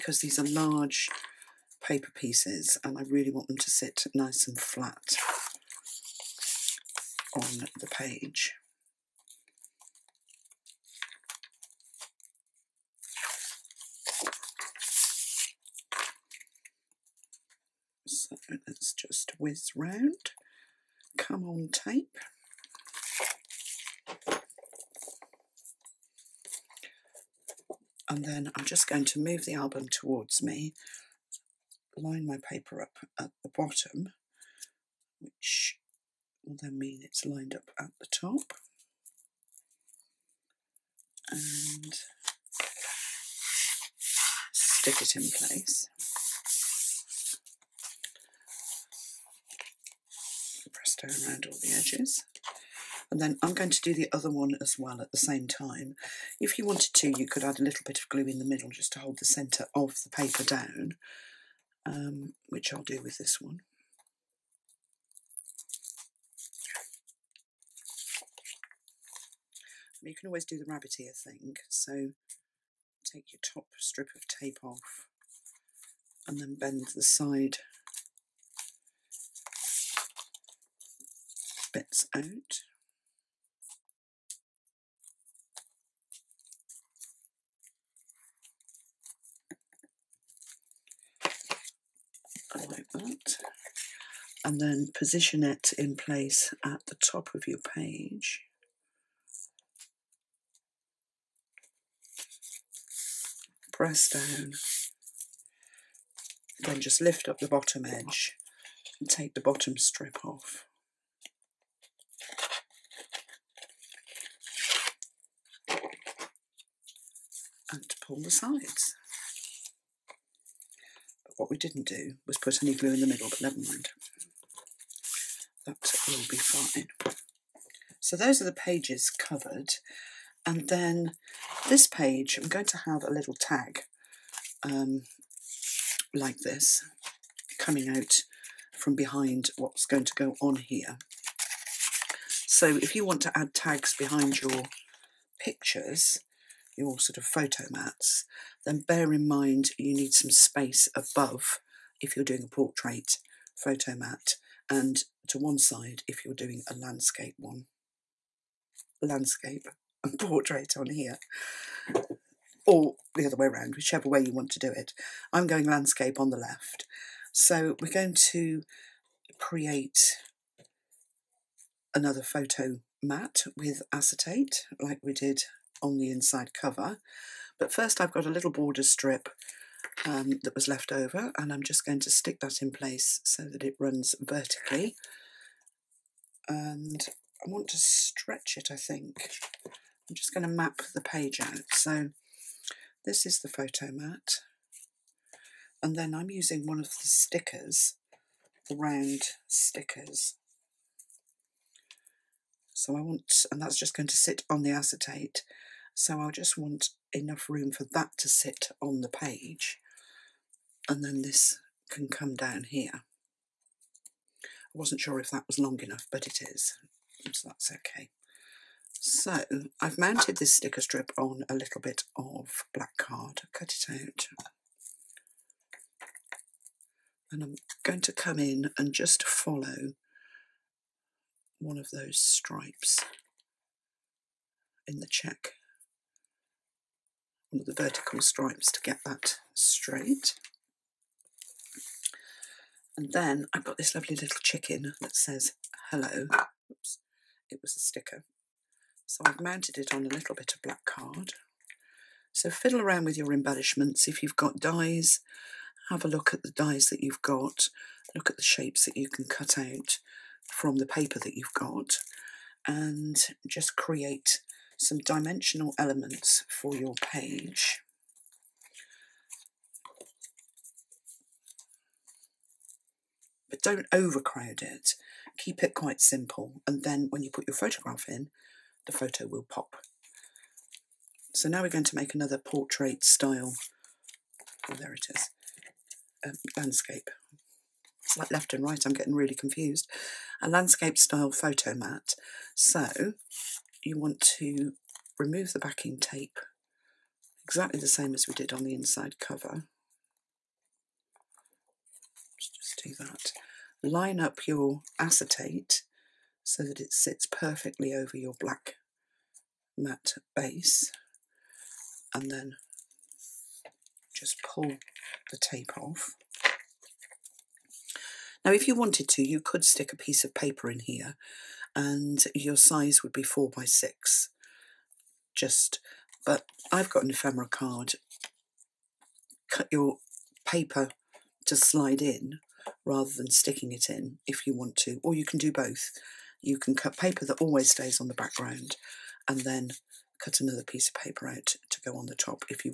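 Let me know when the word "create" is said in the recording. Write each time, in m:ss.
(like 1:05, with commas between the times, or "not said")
2:49, 4:23.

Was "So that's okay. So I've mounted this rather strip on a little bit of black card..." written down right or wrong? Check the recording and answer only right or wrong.
wrong.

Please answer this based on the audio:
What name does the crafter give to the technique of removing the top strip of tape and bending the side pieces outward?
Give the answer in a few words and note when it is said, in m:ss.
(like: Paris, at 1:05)
the rabbit ear thing, at 1:10.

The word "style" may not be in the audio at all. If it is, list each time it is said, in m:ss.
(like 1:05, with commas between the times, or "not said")
4:43, 4:50.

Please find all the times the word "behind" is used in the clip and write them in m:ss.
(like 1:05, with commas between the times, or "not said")
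2:18, 2:23.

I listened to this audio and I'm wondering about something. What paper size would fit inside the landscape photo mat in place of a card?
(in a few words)
4 by 6.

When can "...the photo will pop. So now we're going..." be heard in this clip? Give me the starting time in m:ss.
4:38.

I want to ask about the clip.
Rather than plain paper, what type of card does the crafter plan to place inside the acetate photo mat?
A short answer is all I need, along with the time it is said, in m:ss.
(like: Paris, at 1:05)
ephemera card, at 5:27.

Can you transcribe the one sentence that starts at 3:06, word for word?
And I want to stretch it, I think.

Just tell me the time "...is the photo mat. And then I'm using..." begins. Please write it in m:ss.
3:13.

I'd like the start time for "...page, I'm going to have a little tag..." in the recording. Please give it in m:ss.
2:11.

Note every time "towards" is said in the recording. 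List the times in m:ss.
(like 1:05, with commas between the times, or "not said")
0:29.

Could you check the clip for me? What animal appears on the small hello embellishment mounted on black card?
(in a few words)
chicken.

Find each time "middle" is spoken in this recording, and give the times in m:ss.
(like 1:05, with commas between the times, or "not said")
0:58, 2:03.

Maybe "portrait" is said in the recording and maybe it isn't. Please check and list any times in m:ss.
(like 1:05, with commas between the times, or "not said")
2:32, 2:40, 4:42.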